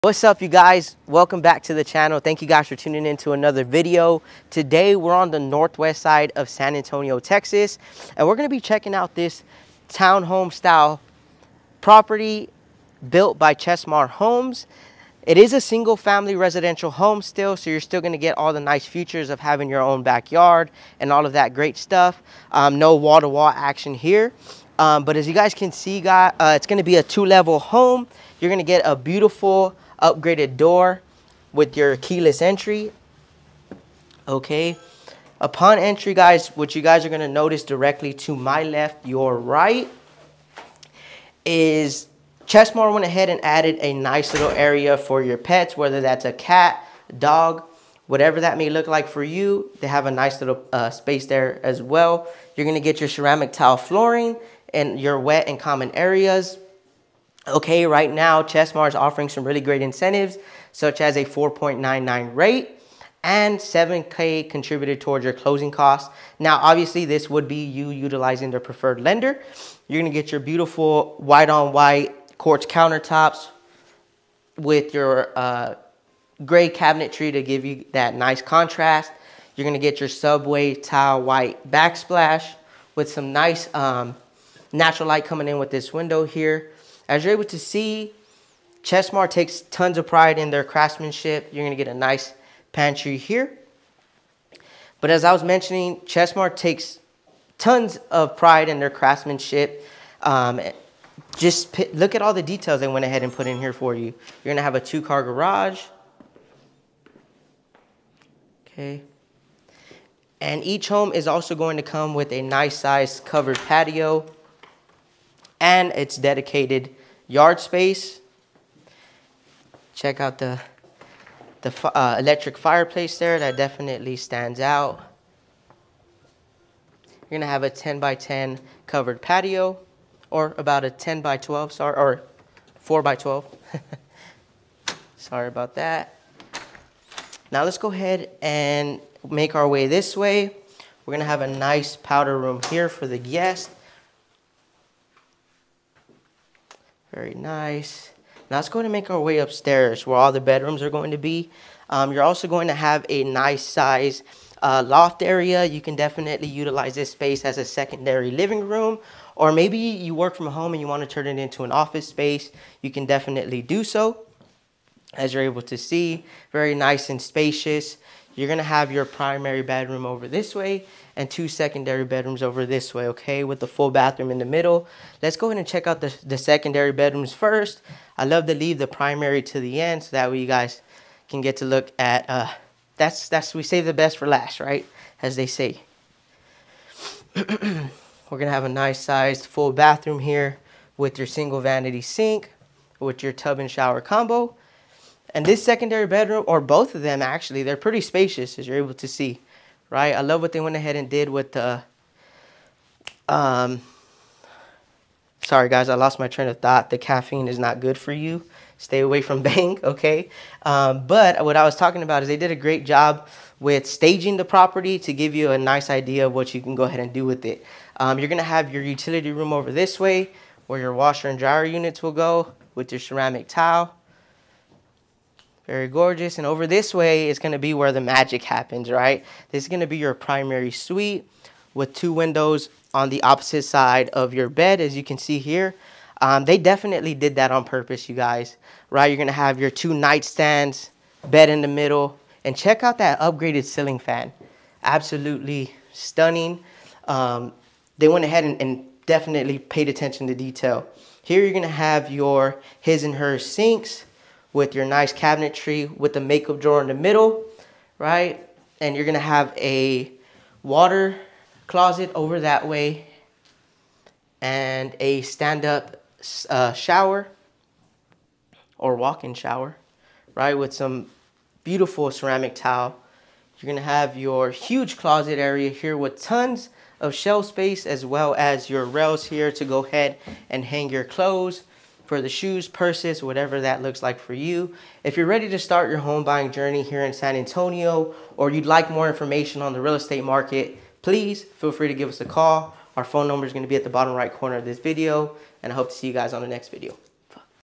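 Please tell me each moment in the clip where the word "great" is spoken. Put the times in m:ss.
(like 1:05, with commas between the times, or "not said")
0:21, 0:59, 3:32.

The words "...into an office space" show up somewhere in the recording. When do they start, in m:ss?
2:41.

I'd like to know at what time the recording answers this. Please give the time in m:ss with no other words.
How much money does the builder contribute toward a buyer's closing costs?
1:03.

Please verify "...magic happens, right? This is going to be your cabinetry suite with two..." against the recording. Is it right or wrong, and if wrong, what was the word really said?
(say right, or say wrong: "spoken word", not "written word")
wrong: "primary", not "cabinetry".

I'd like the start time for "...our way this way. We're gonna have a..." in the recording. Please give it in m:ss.
2:19.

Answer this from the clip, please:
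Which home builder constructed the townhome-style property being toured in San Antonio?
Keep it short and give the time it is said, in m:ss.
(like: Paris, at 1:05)
Chesmar Homes, at 0:13.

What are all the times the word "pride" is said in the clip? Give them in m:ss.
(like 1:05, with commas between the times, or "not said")
1:30, 1:38.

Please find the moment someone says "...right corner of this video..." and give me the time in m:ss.
4:54.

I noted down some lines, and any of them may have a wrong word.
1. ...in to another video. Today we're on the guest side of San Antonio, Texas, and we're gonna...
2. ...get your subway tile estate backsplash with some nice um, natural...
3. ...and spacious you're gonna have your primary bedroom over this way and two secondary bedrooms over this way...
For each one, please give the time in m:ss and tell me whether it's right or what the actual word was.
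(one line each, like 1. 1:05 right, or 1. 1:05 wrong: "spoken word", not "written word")
1. 0:03 wrong: "northwest", not "guest"
2. 1:19 wrong: "white", not "estate"
3. 2:47 right.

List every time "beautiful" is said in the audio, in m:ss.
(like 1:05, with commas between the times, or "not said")
0:28, 1:10, 4:31.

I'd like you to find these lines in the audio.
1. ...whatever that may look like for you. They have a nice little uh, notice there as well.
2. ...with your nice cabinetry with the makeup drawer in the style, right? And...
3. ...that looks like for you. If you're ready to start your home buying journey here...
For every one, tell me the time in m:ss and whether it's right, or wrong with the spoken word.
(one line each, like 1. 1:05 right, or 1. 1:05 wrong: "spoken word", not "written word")
1. 0:48 wrong: "space", not "notice"
2. 4:14 wrong: "middle", not "style"
3. 4:43 right.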